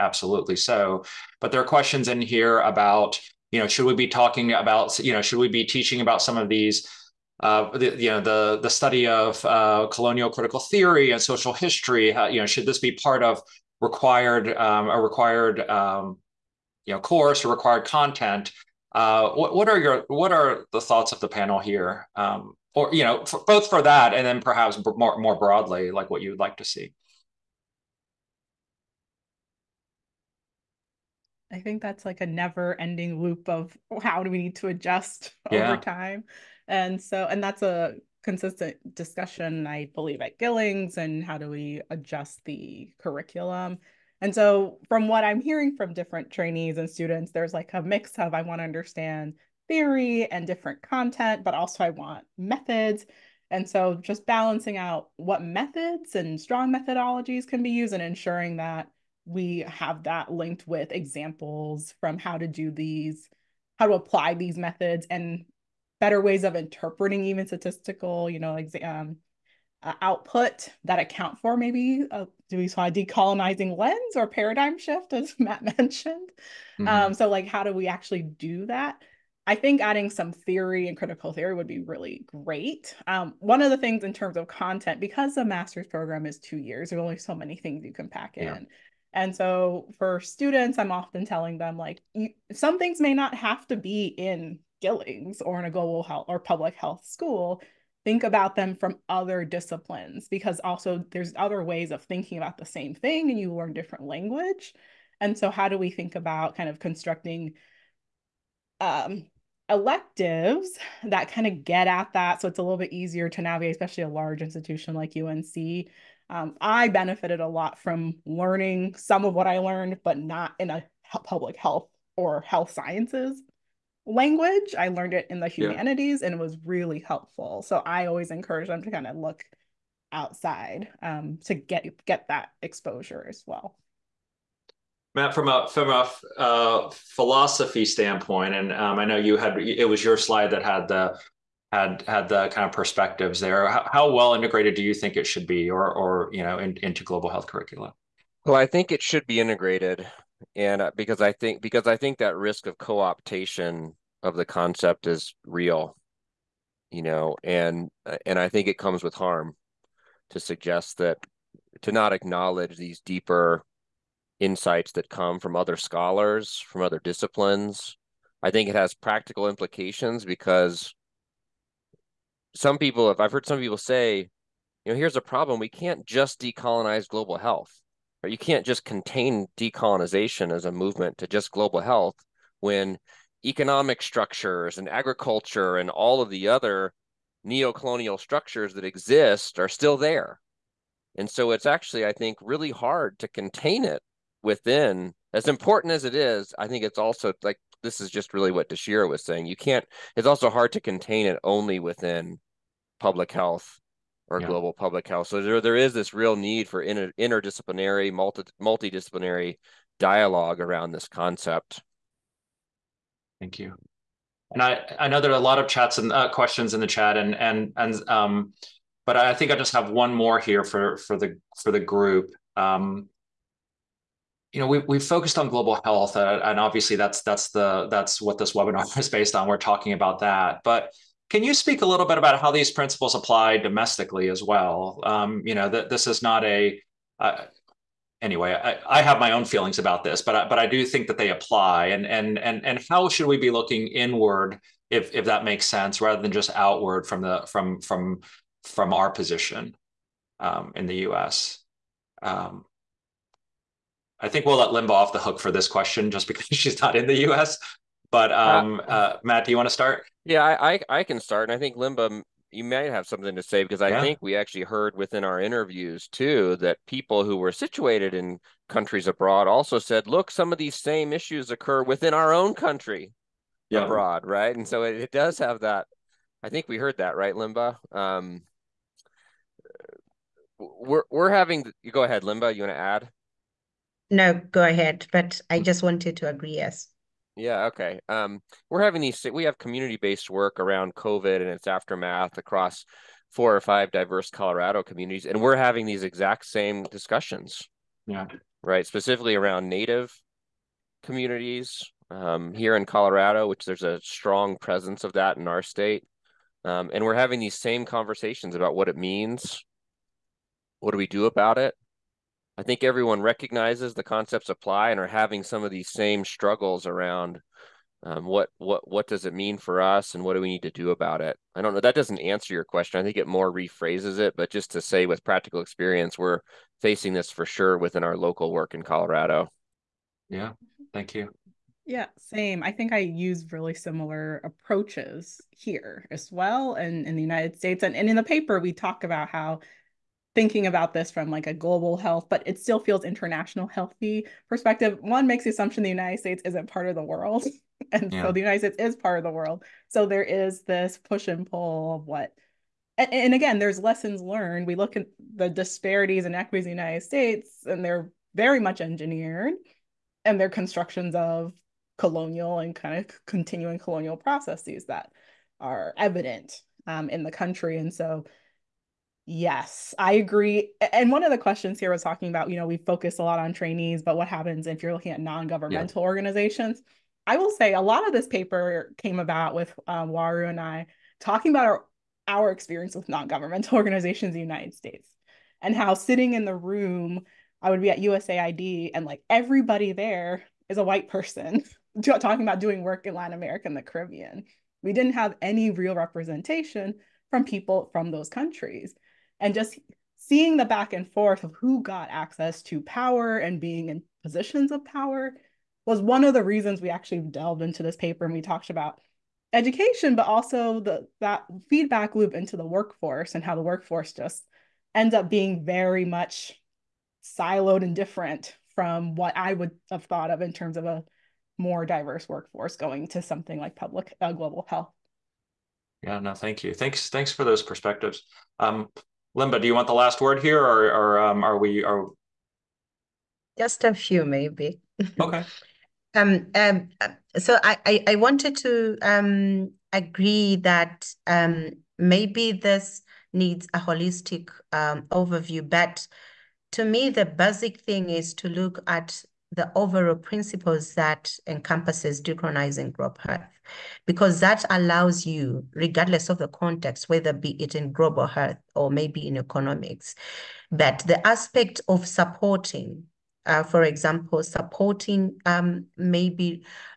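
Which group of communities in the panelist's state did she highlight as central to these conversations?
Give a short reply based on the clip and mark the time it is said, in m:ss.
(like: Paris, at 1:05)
Native communities, at 4:59.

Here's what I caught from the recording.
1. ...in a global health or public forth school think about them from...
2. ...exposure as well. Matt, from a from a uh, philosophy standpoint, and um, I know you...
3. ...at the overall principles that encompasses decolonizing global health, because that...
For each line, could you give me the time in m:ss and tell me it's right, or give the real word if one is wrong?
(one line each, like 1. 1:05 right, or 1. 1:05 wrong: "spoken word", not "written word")
1. 1:35 wrong: "health", not "forth"
2. 2:12 right
3. 7:28 right.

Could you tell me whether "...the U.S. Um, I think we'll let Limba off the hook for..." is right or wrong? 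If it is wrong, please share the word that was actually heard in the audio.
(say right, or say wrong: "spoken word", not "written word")
right.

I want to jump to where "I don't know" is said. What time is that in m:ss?
5:21.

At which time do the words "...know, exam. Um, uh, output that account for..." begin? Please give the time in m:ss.
1:08.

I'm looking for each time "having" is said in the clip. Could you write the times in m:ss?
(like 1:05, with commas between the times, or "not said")
4:41, 4:48, 4:55, 5:07, 5:15.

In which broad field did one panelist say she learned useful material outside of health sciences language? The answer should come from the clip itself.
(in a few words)
humanities.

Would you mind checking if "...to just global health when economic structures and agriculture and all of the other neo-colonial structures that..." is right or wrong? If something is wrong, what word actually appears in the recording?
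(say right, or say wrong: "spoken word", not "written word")
right.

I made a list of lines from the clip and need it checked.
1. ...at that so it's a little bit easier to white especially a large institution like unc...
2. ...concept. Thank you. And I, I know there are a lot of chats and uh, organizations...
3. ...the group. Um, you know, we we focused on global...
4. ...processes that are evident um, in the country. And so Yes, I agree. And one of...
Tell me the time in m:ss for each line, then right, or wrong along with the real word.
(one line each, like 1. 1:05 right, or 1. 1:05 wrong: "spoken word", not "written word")
1. 1:51 wrong: "navigate", not "white"
2. 3:31 wrong: "questions", not "organizations"
3. 3:41 right
4. 6:04 right.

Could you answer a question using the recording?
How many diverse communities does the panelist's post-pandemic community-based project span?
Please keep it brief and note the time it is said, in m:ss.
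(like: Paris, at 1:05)
4 or 5, at 4:53.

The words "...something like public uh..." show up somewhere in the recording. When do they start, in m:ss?
7:03.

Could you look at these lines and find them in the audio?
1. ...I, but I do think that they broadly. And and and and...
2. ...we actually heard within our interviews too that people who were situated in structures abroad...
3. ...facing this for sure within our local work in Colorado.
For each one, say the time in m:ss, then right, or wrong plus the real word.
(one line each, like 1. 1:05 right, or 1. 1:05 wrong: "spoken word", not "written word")
1. 4:00 wrong: "apply", not "broadly"
2. 4:24 wrong: "countries", not "structures"
3. 5:26 right.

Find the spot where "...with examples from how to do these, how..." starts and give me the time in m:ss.
1:00.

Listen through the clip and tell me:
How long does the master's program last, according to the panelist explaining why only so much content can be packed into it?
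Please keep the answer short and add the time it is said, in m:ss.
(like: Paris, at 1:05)
2 years, at 1:26.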